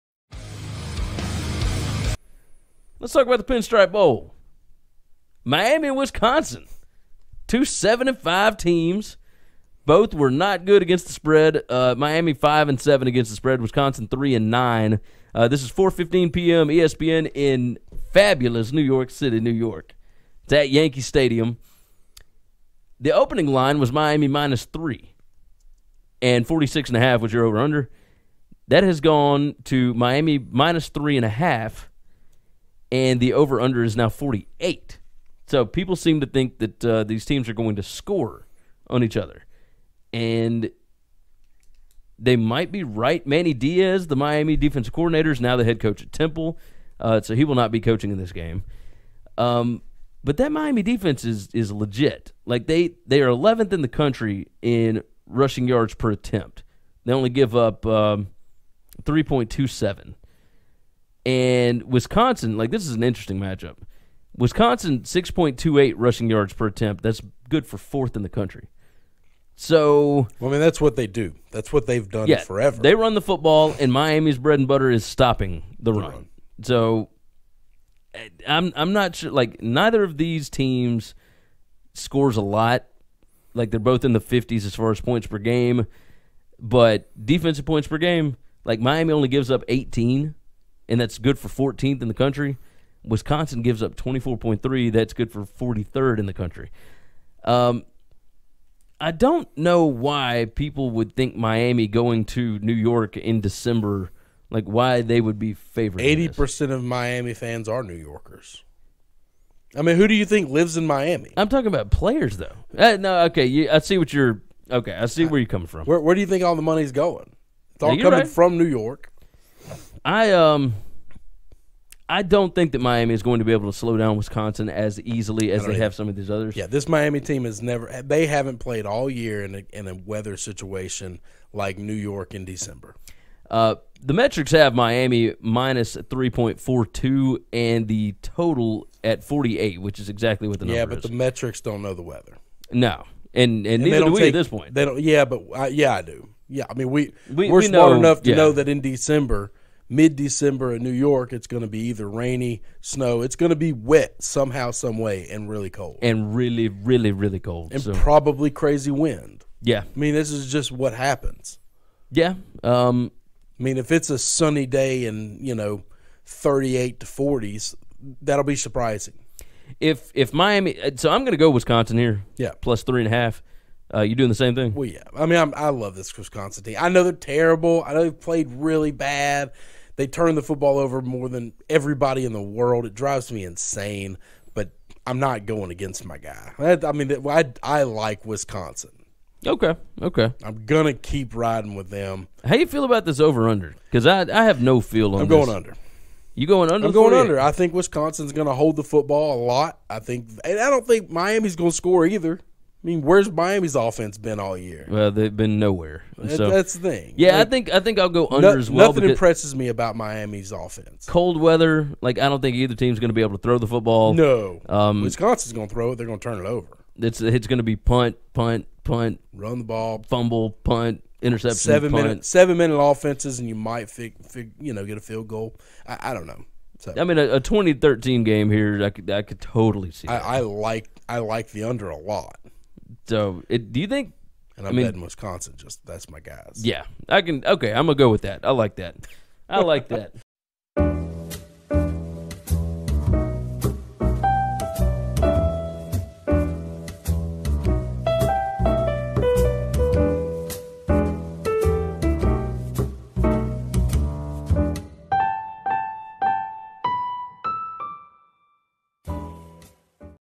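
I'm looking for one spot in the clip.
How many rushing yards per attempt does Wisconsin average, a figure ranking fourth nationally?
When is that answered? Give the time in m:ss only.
1:05.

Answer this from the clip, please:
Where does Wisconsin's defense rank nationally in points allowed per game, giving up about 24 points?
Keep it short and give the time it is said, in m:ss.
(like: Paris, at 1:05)
43rd, at 1:35.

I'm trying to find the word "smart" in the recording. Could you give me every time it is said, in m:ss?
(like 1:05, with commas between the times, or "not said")
2:27.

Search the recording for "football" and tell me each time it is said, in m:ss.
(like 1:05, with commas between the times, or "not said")
1:13, 3:00, 3:18, 3:33.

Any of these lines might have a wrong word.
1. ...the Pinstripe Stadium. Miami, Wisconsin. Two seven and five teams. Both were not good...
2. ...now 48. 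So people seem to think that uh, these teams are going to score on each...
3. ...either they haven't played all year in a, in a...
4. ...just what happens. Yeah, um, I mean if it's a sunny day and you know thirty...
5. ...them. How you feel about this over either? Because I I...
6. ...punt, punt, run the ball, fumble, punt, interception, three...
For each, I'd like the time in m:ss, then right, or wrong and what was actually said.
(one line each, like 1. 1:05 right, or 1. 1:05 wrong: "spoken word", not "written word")
1. 0:03 wrong: "Bowl", not "Stadium"
2. 0:33 right
3. 2:07 wrong: "never", not "either"
4. 2:40 right
5. 3:11 wrong: "under", not "either"
6. 3:38 wrong: "seven", not "three".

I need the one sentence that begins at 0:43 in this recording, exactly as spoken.
Manny Diaz, the Miami defensive coordinator, is now the head coach at Temple.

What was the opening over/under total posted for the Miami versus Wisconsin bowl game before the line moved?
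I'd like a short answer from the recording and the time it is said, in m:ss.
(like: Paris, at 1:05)
46.5, at 0:26.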